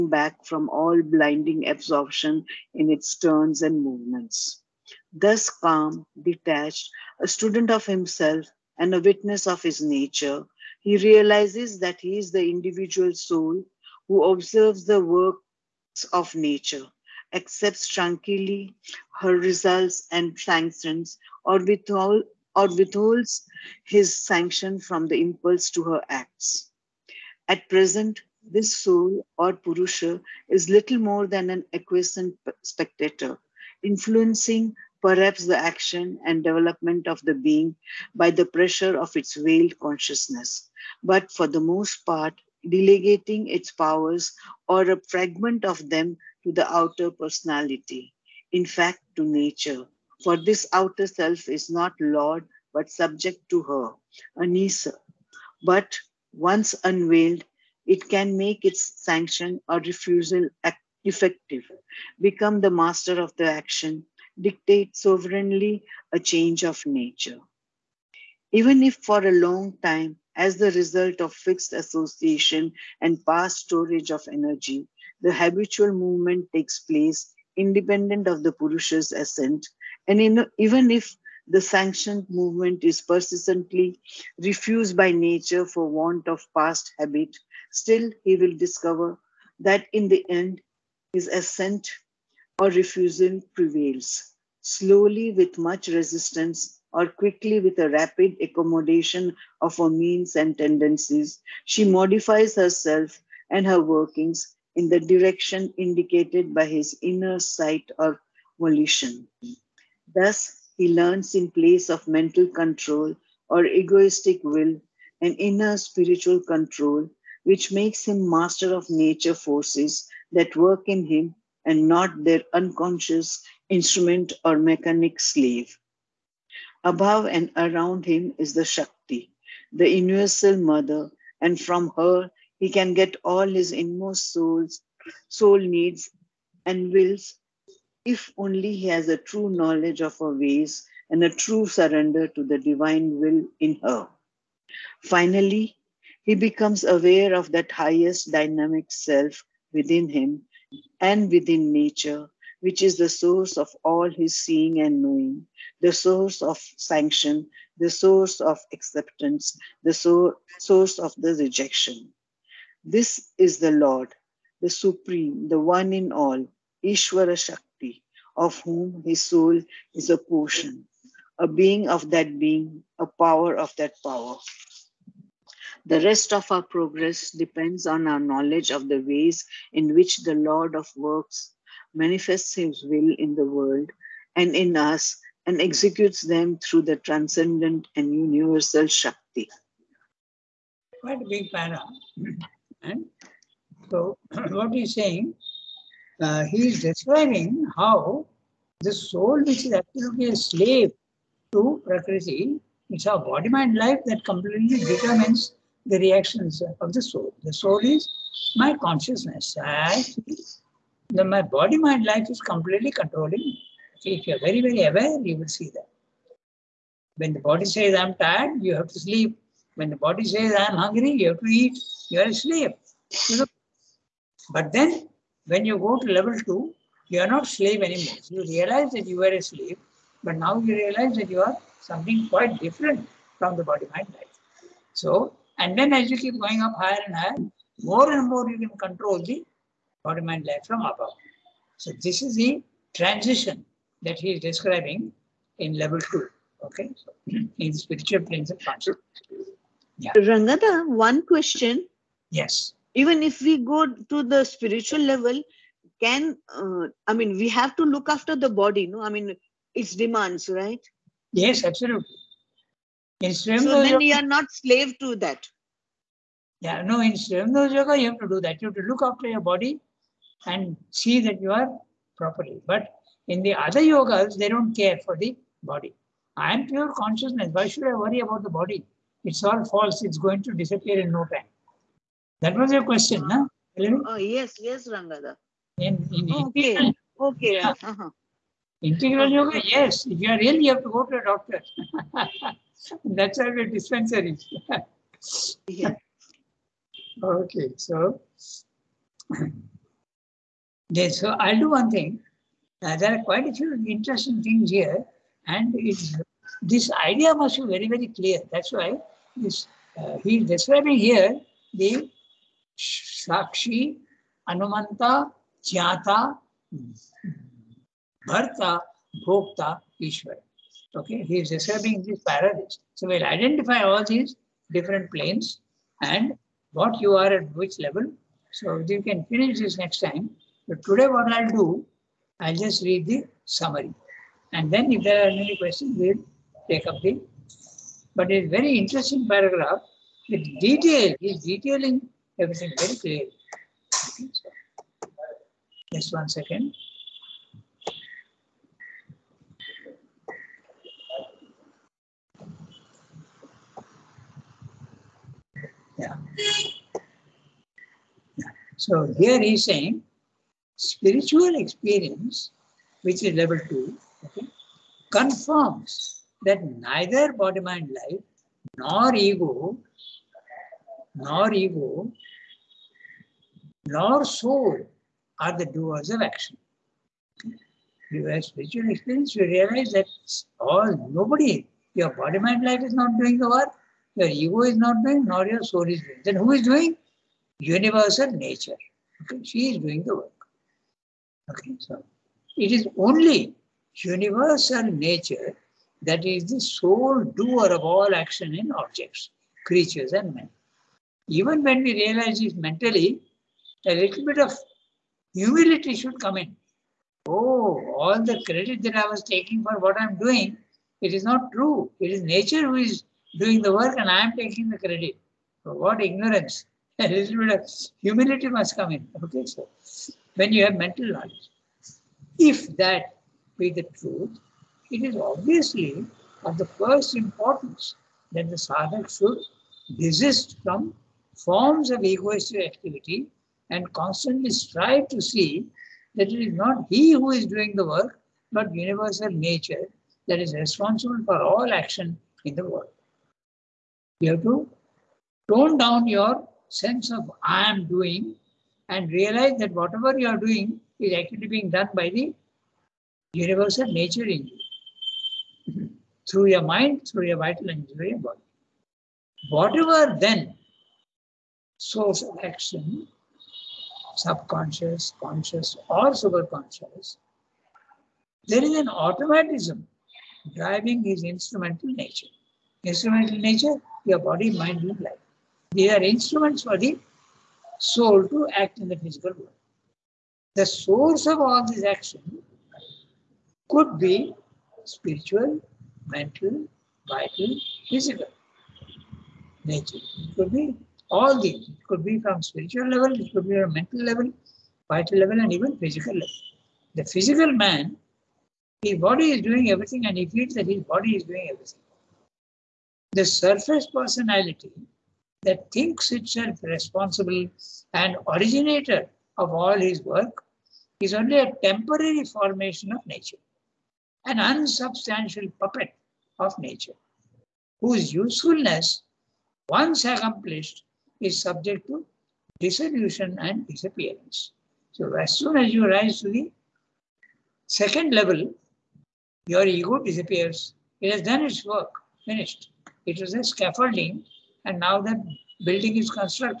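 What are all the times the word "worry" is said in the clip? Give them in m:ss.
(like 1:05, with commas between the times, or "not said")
4:37.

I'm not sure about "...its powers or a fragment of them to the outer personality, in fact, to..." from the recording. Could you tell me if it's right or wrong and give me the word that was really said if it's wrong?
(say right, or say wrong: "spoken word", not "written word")
right.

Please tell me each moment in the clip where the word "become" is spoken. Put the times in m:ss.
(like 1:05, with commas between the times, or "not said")
1:02, 2:26.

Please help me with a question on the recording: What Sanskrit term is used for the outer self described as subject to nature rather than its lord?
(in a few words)
Anisa.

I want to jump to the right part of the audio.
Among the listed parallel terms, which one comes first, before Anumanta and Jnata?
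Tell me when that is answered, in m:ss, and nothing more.
5:12.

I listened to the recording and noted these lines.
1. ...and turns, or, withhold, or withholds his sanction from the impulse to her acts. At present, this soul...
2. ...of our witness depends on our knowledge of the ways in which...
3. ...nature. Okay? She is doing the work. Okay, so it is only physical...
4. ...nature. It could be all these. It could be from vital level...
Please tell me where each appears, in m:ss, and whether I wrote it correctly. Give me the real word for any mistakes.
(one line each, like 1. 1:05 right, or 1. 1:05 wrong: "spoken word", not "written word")
1. 0:20 wrong: "sanctions", not "turns"
2. 2:56 wrong: "progress", not "witness"
3. 6:28 wrong: "universal", not "physical"
4. 8:09 wrong: "spiritual", not "vital".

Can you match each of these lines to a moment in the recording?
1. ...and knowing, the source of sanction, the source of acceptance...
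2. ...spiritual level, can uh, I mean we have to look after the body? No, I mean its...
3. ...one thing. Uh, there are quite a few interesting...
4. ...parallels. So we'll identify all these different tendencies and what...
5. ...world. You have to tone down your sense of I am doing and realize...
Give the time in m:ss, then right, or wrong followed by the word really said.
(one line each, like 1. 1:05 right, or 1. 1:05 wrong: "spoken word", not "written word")
1. 2:34 right
2. 4:14 right
3. 5:01 right
4. 5:22 wrong: "planes", not "tendencies"
5. 7:22 right.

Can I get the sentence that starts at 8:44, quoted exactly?
So as soon as you rise to the second level, your ego disappears.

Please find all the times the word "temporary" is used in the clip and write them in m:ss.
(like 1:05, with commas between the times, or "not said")
8:31.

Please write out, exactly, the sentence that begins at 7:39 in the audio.
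Whatever then source of action, subconscious, conscious, or superconscious, there is an automatism driving his instrumental nature.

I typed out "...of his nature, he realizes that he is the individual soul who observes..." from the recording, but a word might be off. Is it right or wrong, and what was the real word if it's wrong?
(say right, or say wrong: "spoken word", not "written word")
right.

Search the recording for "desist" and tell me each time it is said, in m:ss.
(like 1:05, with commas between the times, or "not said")
7:09.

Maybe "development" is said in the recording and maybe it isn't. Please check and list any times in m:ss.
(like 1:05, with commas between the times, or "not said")
0:36.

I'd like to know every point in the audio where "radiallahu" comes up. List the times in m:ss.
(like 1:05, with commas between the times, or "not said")
not said.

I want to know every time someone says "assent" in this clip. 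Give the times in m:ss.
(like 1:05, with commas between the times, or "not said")
1:19, 1:31.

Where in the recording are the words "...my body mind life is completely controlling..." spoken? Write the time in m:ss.
3:31.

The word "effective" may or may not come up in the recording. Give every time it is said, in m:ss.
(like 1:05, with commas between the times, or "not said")
1:01.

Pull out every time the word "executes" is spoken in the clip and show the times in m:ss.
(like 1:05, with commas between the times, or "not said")
3:05.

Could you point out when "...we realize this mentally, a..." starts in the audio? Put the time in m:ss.
6:41.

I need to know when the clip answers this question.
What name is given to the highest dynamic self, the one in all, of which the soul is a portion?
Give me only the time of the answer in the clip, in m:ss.
2:46.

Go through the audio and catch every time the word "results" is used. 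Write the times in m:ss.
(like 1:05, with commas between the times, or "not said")
0:19, 1:10.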